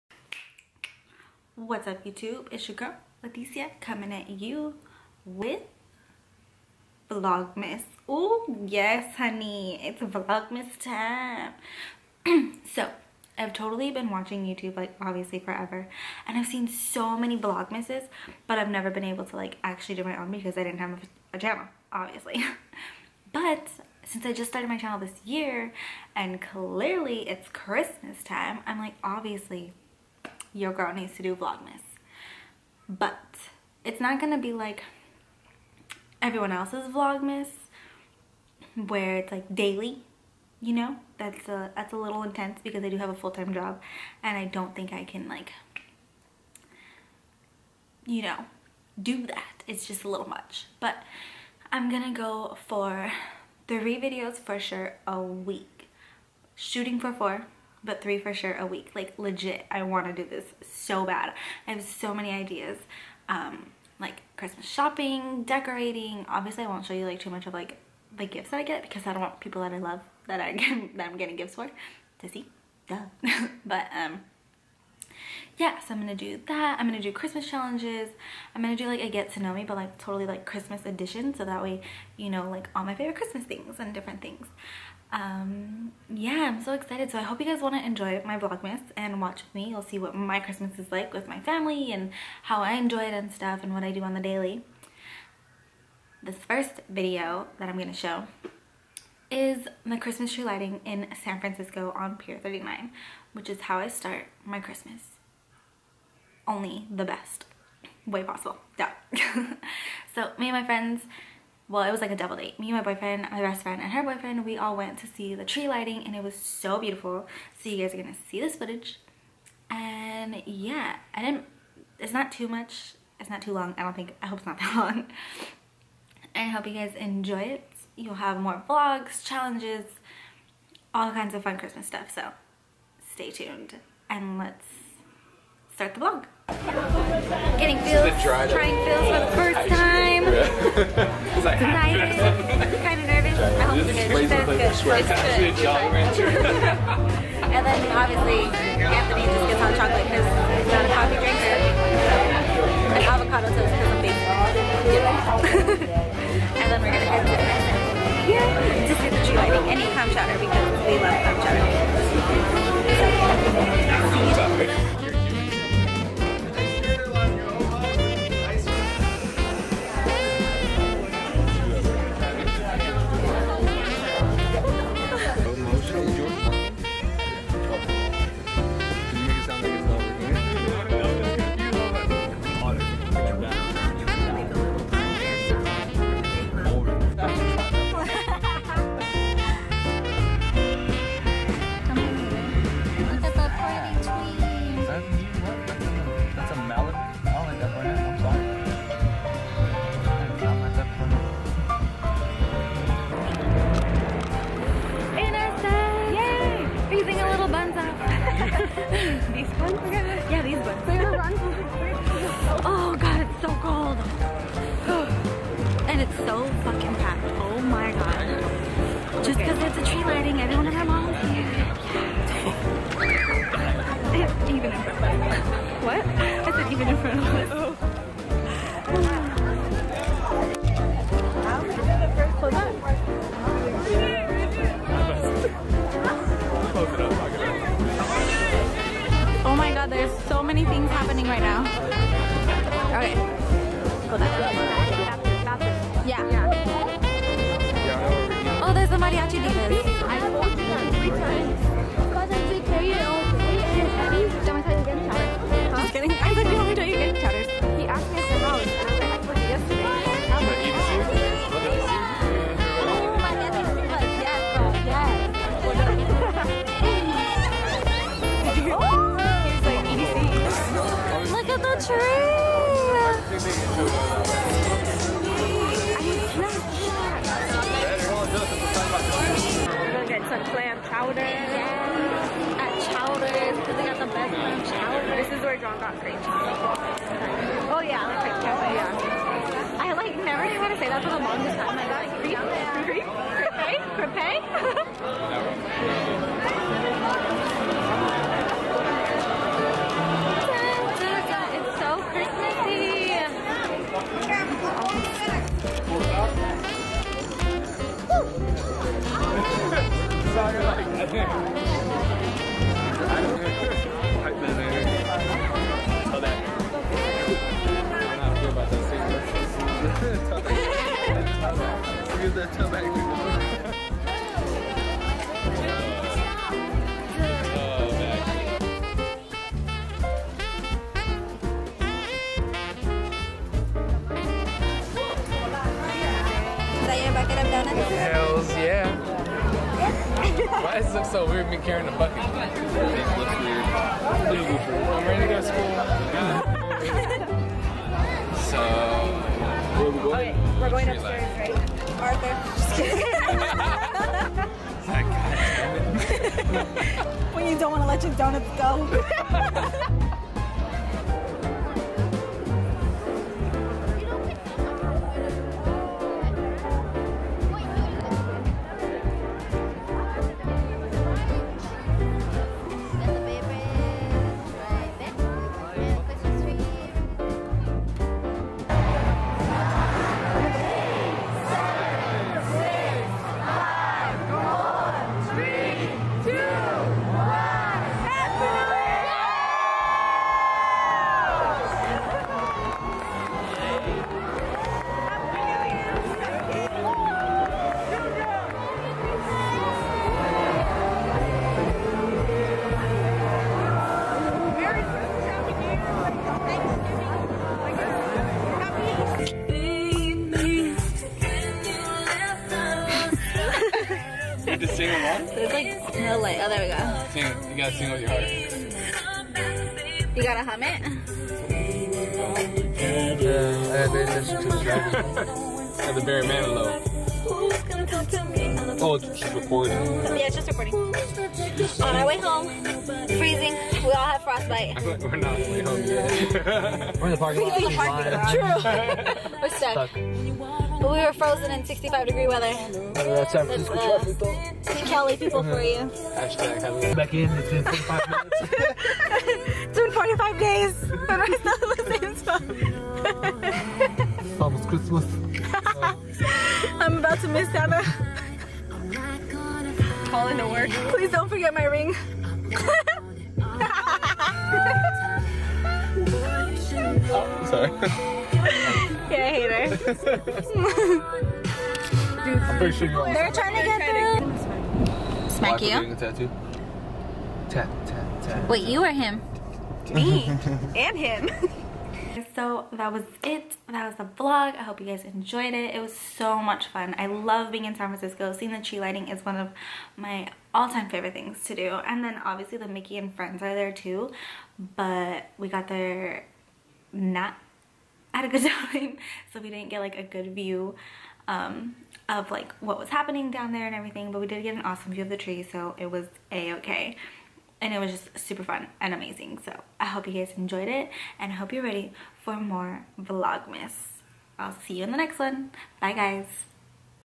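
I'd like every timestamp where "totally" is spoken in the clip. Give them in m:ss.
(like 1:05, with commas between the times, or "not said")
0:13, 1:19.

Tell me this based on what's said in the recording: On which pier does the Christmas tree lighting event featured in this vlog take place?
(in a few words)
Pier 39.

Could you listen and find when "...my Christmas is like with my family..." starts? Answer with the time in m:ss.
1:30.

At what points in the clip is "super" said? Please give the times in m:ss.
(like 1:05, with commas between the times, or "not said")
8:28.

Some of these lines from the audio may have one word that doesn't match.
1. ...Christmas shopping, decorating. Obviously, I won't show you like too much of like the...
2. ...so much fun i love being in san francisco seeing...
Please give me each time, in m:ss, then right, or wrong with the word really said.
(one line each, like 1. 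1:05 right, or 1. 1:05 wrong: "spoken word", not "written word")
1. 1:04 right
2. 8:05 right.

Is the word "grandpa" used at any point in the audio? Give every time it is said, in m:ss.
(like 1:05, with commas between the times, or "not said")
not said.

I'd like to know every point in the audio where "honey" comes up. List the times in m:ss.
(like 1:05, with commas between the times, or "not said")
0:09.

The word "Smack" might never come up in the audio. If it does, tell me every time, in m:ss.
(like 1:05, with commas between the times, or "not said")
7:55.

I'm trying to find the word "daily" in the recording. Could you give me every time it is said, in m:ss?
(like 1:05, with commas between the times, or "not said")
0:39, 1:34.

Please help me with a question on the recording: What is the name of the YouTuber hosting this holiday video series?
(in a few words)
Leticia.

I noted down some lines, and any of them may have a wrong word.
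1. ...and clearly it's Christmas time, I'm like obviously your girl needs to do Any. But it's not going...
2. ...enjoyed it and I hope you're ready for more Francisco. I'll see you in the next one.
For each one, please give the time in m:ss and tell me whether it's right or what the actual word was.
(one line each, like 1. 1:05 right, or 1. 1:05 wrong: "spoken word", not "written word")
1. 0:26 wrong: "Vlogmas", not "Any"
2. 8:30 wrong: "Vlogmas", not "Francisco".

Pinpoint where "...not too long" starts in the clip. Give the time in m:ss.
2:03.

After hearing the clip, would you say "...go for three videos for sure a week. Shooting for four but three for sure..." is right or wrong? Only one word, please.
right.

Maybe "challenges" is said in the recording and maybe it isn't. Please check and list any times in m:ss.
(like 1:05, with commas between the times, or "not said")
1:17, 2:09.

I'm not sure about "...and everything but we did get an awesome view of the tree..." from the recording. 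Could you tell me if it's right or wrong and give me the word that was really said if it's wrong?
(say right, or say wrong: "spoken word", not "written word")
right.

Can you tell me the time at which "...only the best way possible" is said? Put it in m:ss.
1:46.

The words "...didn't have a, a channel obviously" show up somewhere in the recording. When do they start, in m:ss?
0:20.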